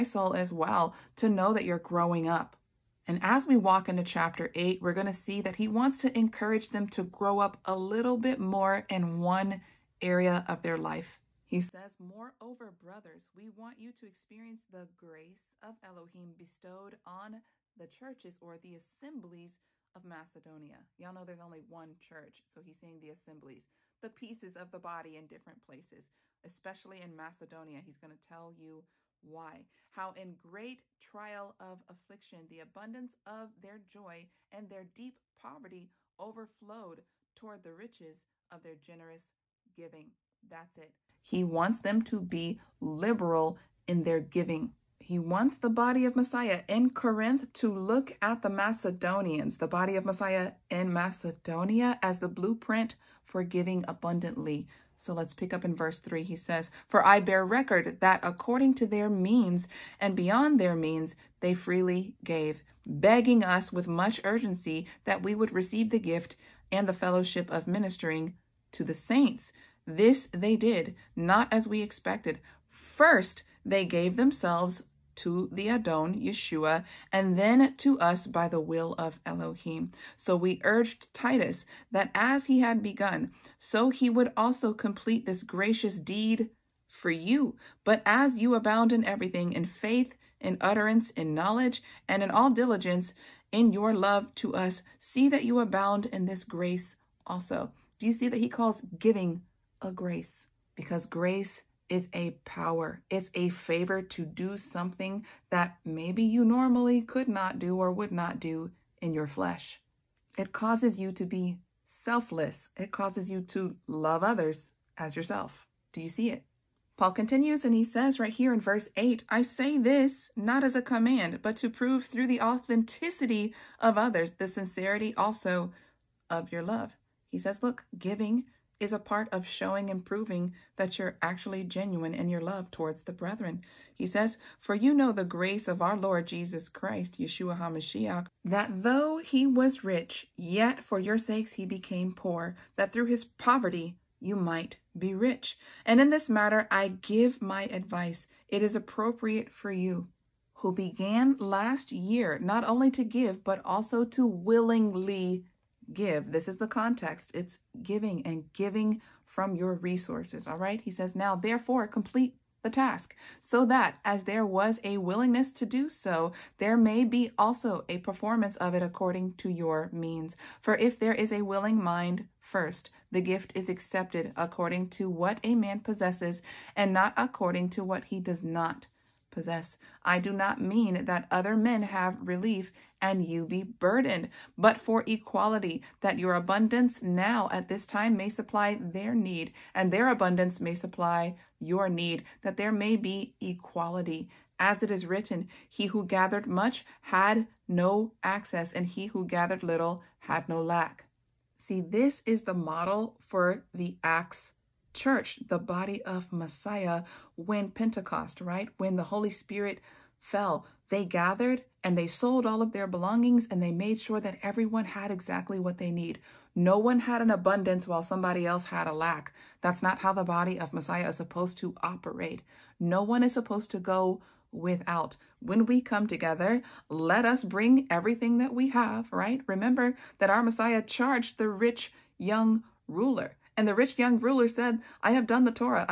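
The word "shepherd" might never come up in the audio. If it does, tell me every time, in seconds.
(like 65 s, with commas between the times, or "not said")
not said.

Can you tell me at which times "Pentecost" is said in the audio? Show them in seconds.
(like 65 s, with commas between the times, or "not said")
207 s.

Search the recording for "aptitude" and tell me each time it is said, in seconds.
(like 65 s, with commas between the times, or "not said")
not said.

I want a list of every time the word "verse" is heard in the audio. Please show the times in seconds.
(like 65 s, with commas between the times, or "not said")
55 s, 118 s.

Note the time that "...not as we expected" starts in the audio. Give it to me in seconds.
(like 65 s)
71 s.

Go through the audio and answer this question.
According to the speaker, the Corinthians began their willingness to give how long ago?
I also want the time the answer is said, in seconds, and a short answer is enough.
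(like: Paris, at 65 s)
Last year, at 151 s.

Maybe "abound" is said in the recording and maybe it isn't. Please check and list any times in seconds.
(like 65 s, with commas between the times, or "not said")
88 s, 95 s.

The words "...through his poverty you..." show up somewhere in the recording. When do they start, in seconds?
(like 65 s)
142 s.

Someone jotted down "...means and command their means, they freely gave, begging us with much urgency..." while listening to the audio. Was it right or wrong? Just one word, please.
wrong.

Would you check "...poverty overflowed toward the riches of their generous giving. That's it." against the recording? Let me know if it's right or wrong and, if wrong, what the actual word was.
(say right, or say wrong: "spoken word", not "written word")
right.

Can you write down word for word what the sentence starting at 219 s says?
That's not how the body of Messiah is supposed to operate.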